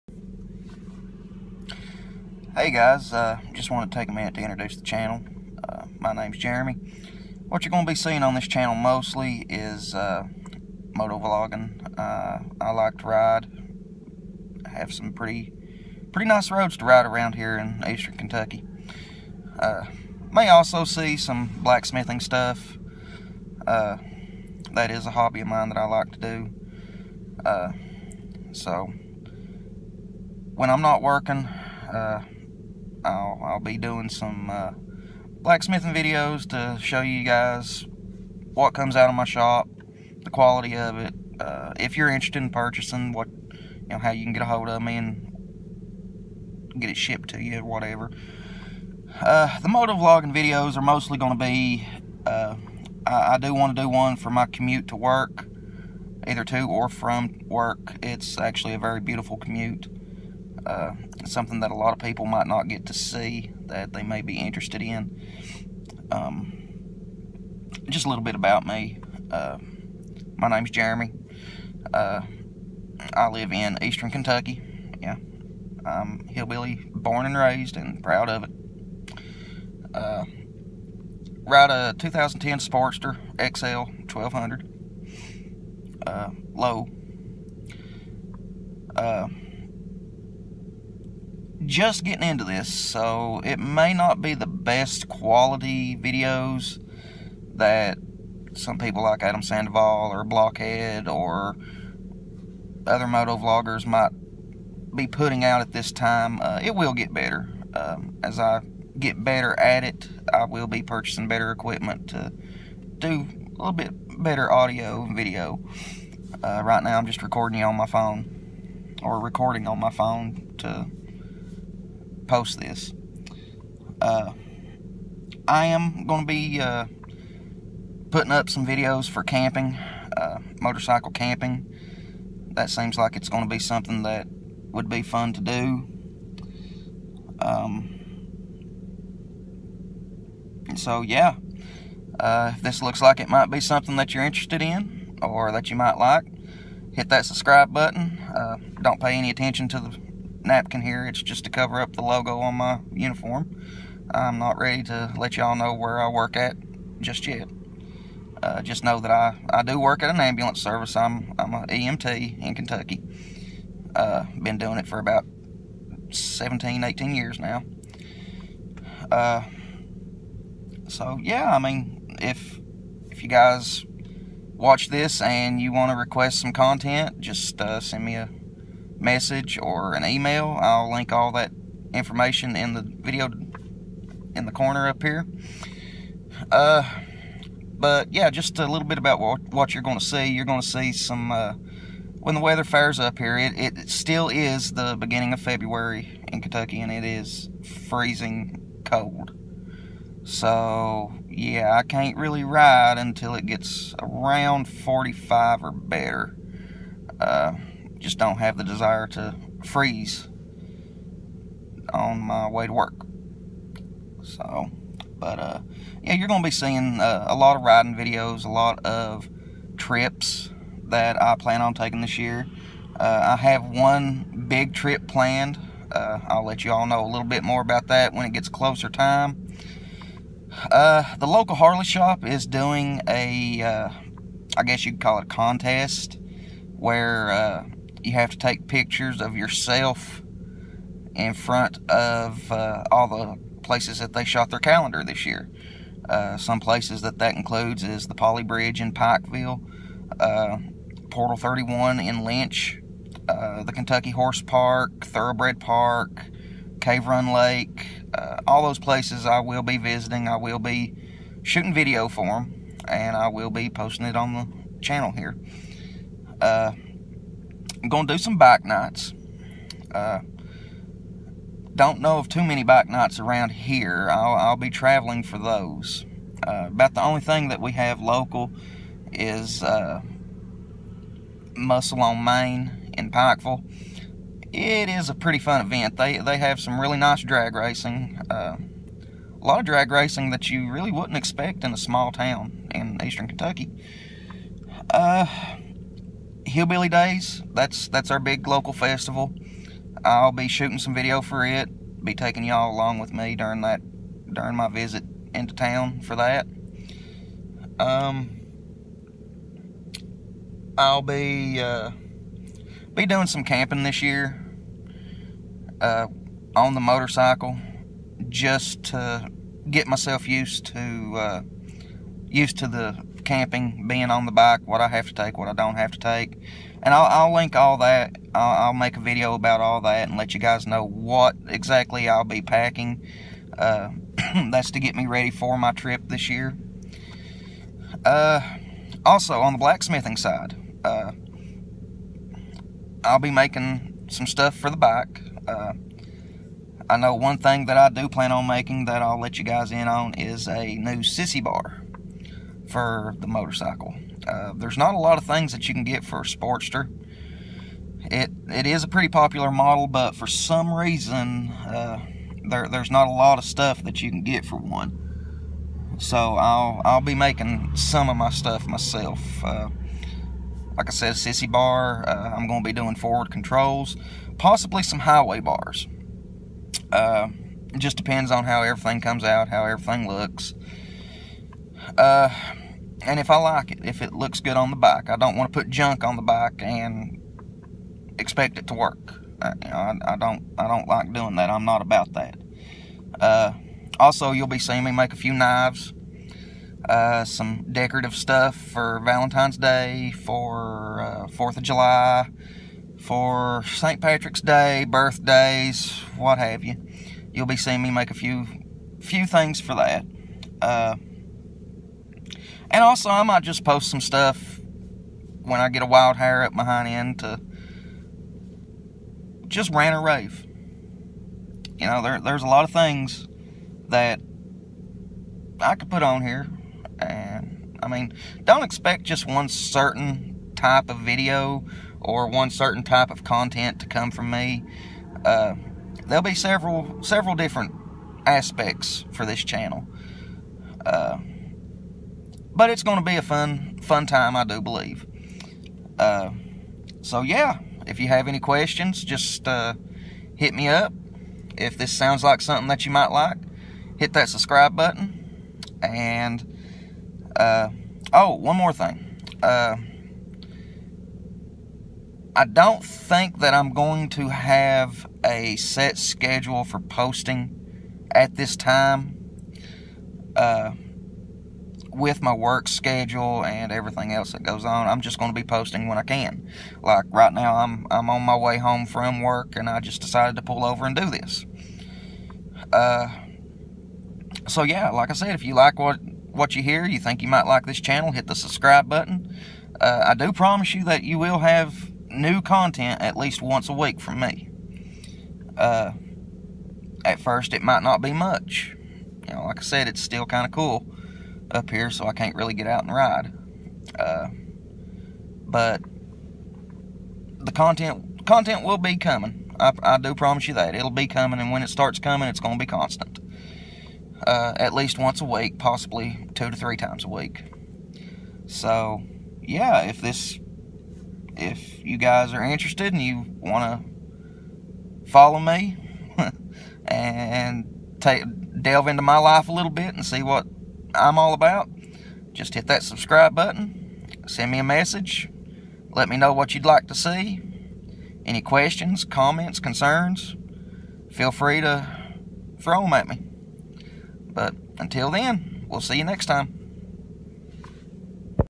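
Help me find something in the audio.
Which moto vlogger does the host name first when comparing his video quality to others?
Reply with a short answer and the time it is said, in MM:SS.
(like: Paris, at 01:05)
Adam Sandoval, at 01:39.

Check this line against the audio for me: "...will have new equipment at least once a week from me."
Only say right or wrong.
wrong.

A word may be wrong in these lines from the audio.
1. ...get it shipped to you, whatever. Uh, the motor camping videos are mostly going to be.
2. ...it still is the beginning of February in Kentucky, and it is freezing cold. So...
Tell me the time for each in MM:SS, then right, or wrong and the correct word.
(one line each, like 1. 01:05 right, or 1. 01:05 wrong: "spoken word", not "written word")
1. 00:46 wrong: "vlogging", not "camping"
2. 03:13 right.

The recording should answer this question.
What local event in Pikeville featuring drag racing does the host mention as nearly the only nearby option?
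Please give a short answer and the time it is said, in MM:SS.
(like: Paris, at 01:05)
Muscle on Main, at 04:41.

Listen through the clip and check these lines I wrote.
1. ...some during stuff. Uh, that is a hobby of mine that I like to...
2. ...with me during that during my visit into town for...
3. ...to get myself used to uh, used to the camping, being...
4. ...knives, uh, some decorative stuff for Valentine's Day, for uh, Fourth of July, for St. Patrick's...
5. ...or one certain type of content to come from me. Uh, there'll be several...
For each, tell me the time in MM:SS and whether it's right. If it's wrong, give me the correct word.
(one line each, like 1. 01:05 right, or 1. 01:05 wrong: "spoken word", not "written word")
1. 00:21 wrong: "blacksmithing", not "during"
2. 05:02 right
3. 05:18 right
4. 06:35 right
5. 07:11 right.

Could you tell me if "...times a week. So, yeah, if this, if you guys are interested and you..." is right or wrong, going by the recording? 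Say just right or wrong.
right.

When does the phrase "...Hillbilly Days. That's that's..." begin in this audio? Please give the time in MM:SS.
04:56.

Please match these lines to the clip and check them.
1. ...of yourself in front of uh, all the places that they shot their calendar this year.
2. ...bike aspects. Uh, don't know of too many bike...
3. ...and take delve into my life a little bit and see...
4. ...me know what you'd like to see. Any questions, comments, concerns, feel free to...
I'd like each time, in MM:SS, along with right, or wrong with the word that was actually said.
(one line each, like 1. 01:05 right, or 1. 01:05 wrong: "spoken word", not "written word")
1. 03:59 right
2. 04:28 wrong: "nights", not "aspects"
3. 08:46 right
4. 08:56 right.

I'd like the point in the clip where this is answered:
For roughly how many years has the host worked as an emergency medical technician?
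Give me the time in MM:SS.
02:46.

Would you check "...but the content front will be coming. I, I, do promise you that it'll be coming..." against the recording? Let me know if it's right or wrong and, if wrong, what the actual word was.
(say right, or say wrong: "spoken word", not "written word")
wrong: "content", not "front".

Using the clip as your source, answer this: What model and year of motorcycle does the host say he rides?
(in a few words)
2010 Sportster XL 1200.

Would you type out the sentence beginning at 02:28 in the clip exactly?
Uh, don't pay any attention to the napkin here.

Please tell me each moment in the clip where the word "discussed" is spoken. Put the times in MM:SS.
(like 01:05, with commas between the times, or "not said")
not said.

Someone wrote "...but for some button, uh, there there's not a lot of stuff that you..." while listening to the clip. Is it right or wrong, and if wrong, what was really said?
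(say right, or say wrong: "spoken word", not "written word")
wrong: "reason", not "button".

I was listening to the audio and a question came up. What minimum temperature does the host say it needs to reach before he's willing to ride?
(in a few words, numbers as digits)
45.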